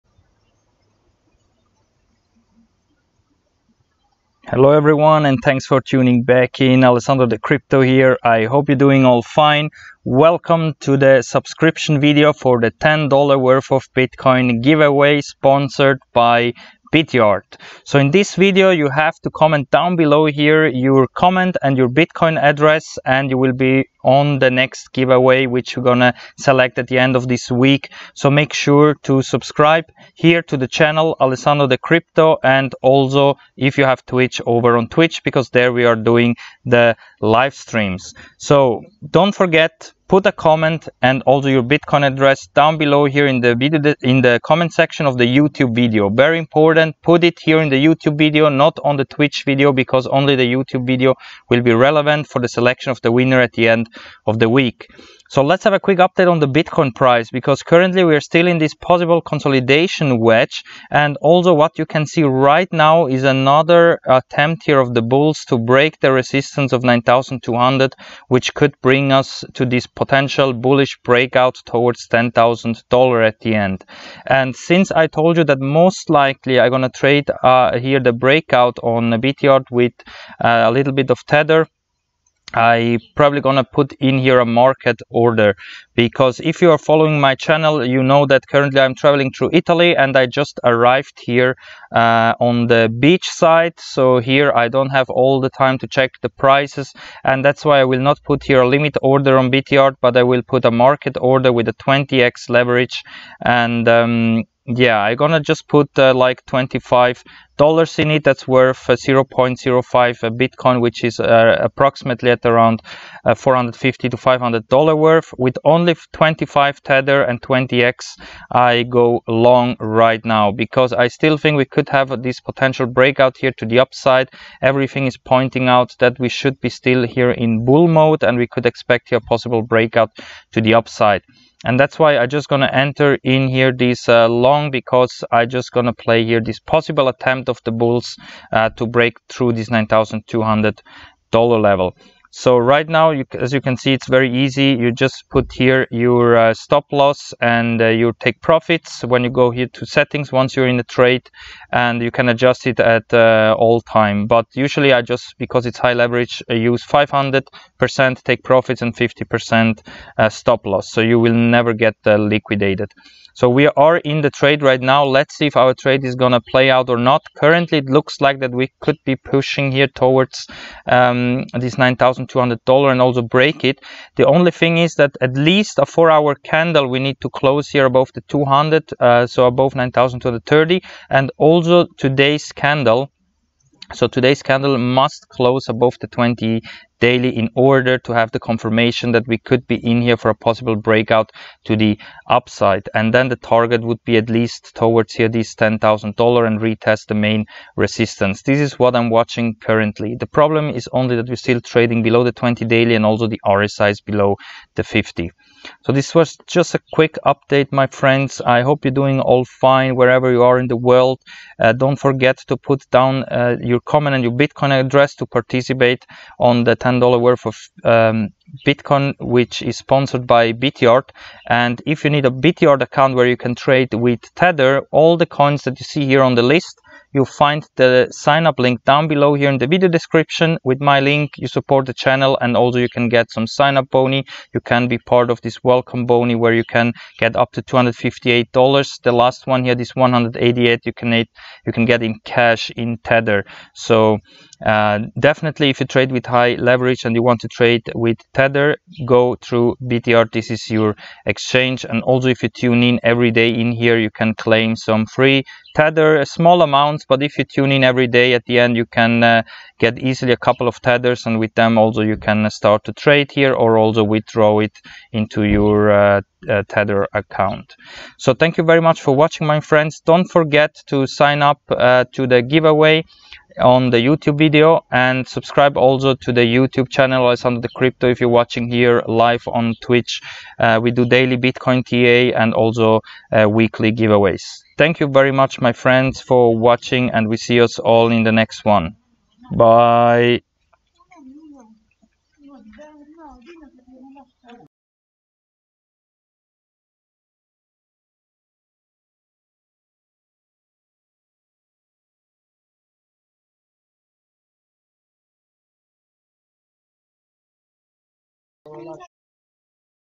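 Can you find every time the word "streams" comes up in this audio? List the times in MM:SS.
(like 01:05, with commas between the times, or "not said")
00:37.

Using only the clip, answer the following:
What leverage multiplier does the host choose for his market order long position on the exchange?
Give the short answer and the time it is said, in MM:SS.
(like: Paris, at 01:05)
20x, at 01:41.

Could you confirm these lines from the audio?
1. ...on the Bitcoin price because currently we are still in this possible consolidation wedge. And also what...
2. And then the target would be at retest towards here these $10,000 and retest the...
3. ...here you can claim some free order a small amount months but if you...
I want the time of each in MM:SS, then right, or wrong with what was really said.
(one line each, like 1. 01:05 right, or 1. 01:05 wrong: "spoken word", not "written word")
1. 00:56 right
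2. 03:12 wrong: "least", not "retest"
3. 04:13 wrong: "tether", not "order".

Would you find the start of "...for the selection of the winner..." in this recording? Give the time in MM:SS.
00:52.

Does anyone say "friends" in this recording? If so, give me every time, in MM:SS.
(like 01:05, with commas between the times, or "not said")
03:27, 04:29, 04:45.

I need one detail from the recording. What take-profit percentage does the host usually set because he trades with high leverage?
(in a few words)
500%.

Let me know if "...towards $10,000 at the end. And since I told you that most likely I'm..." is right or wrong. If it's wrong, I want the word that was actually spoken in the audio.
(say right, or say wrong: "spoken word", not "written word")
right.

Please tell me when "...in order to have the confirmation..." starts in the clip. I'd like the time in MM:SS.
03:07.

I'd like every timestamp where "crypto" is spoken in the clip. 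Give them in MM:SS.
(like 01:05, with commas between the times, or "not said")
00:07, 00:31, 04:37.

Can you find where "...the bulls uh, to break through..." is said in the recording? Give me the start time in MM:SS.
02:17.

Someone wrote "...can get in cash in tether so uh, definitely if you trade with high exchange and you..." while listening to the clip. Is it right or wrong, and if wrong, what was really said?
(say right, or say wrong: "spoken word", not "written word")
wrong: "leverage", not "exchange".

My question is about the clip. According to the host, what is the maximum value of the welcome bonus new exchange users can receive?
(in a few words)
$258.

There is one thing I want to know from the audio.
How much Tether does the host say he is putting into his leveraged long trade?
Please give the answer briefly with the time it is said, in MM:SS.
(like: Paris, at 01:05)
$25, at 01:46.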